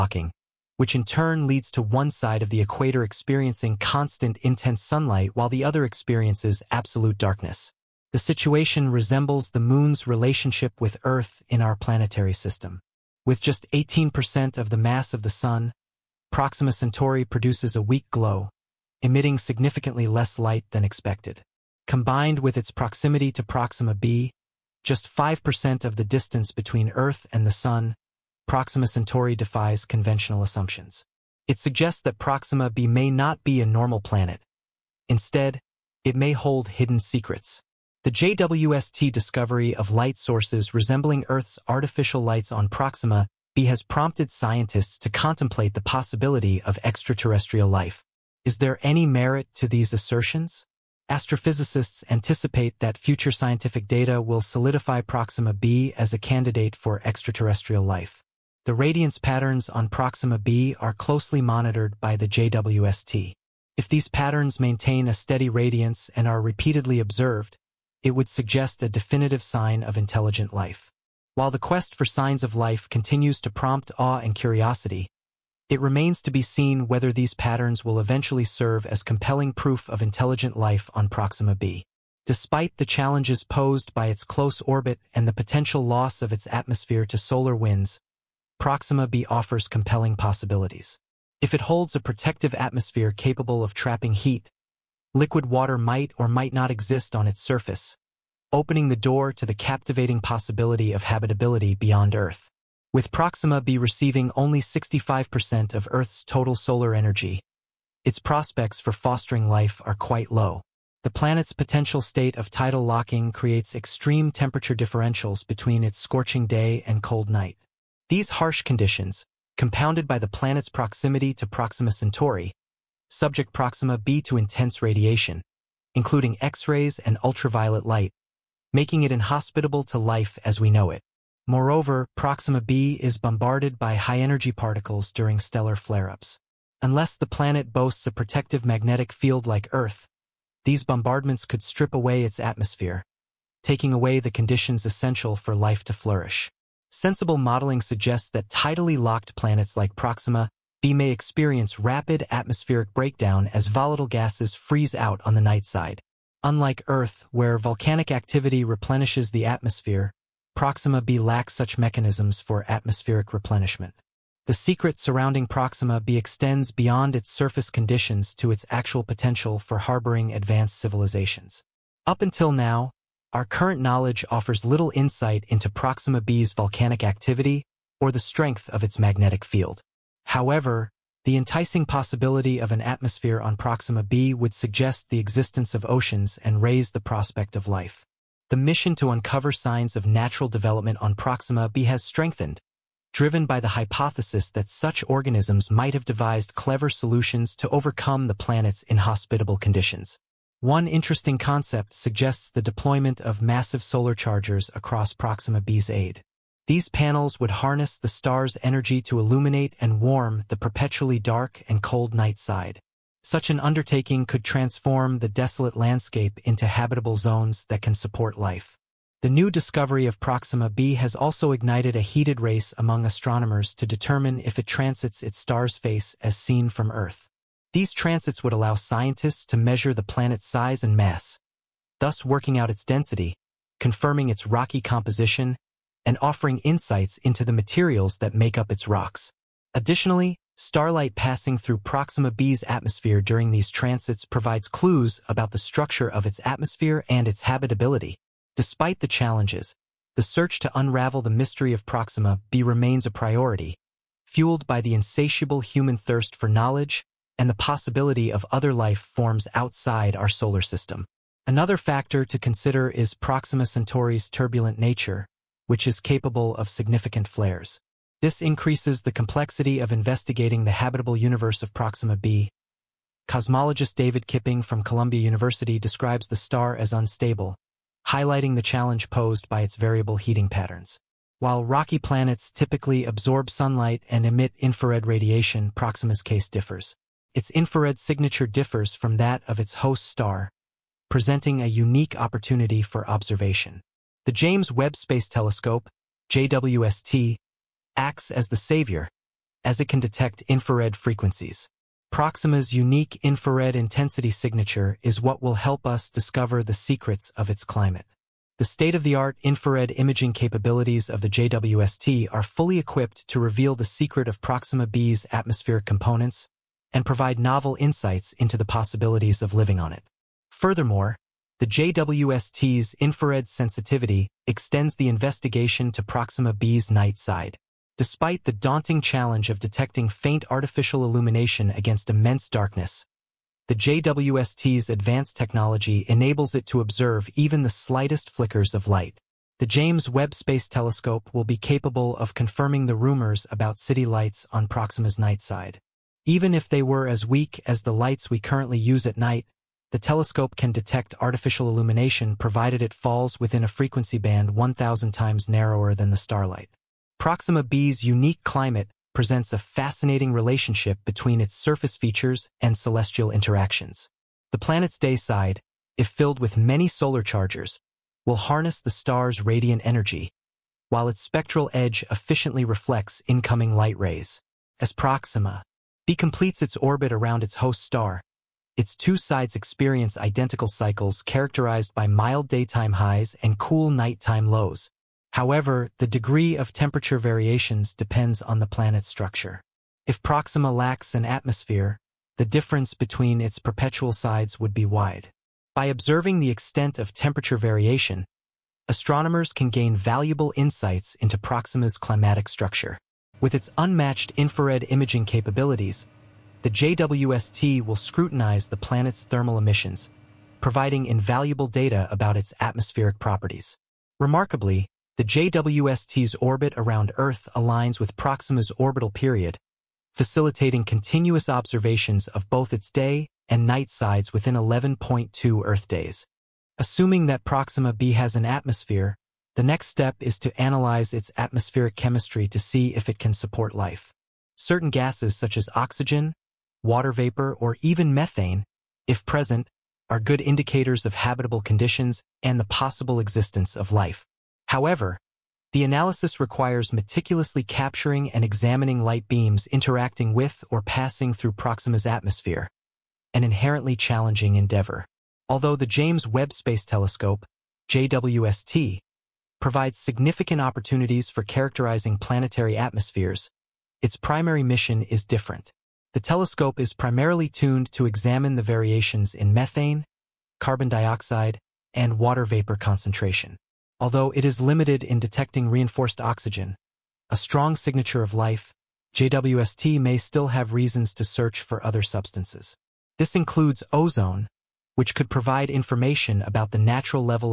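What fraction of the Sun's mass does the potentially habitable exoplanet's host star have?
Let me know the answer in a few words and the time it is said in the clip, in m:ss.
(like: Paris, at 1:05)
18%, at 0:13.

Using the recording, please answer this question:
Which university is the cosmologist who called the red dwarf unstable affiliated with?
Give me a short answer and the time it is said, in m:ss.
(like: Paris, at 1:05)
Columbia University, at 4:34.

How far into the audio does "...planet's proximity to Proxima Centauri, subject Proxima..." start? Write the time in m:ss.
2:00.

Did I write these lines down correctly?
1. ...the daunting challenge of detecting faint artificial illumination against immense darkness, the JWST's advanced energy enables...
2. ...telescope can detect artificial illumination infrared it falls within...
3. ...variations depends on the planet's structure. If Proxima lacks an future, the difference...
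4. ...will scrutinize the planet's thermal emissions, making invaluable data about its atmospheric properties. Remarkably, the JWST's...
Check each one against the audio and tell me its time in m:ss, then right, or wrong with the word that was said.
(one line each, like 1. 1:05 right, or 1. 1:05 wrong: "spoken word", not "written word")
1. 5:28 wrong: "technology", not "energy"
2. 5:49 wrong: "provided", not "infrared"
3. 6:27 wrong: "atmosphere", not "future"
4. 6:47 wrong: "providing", not "making".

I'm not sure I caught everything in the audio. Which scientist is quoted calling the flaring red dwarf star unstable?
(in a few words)
David Kipping.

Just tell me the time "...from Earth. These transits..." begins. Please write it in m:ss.
3:46.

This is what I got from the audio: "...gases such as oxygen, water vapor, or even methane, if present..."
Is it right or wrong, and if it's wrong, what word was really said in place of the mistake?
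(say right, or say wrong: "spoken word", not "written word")
right.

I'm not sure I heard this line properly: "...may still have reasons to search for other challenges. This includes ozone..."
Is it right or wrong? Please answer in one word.
wrong.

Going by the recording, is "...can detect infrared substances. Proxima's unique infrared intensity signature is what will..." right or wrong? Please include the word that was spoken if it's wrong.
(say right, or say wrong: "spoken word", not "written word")
wrong: "frequencies", not "substances".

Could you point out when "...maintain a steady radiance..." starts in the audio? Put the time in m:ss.
1:04.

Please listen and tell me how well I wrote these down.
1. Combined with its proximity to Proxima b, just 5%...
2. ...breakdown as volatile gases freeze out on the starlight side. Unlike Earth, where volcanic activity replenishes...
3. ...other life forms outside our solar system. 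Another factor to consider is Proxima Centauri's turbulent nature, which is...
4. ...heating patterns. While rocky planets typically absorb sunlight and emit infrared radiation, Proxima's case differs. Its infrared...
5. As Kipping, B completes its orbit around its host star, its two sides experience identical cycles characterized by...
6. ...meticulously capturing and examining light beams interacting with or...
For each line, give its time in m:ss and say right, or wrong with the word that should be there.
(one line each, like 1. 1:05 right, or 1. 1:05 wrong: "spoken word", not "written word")
1. 0:21 right
2. 2:32 wrong: "night", not "starlight"
3. 4:18 right
4. 4:40 right
5. 6:14 wrong: "Proxima", not "Kipping"
6. 7:26 right.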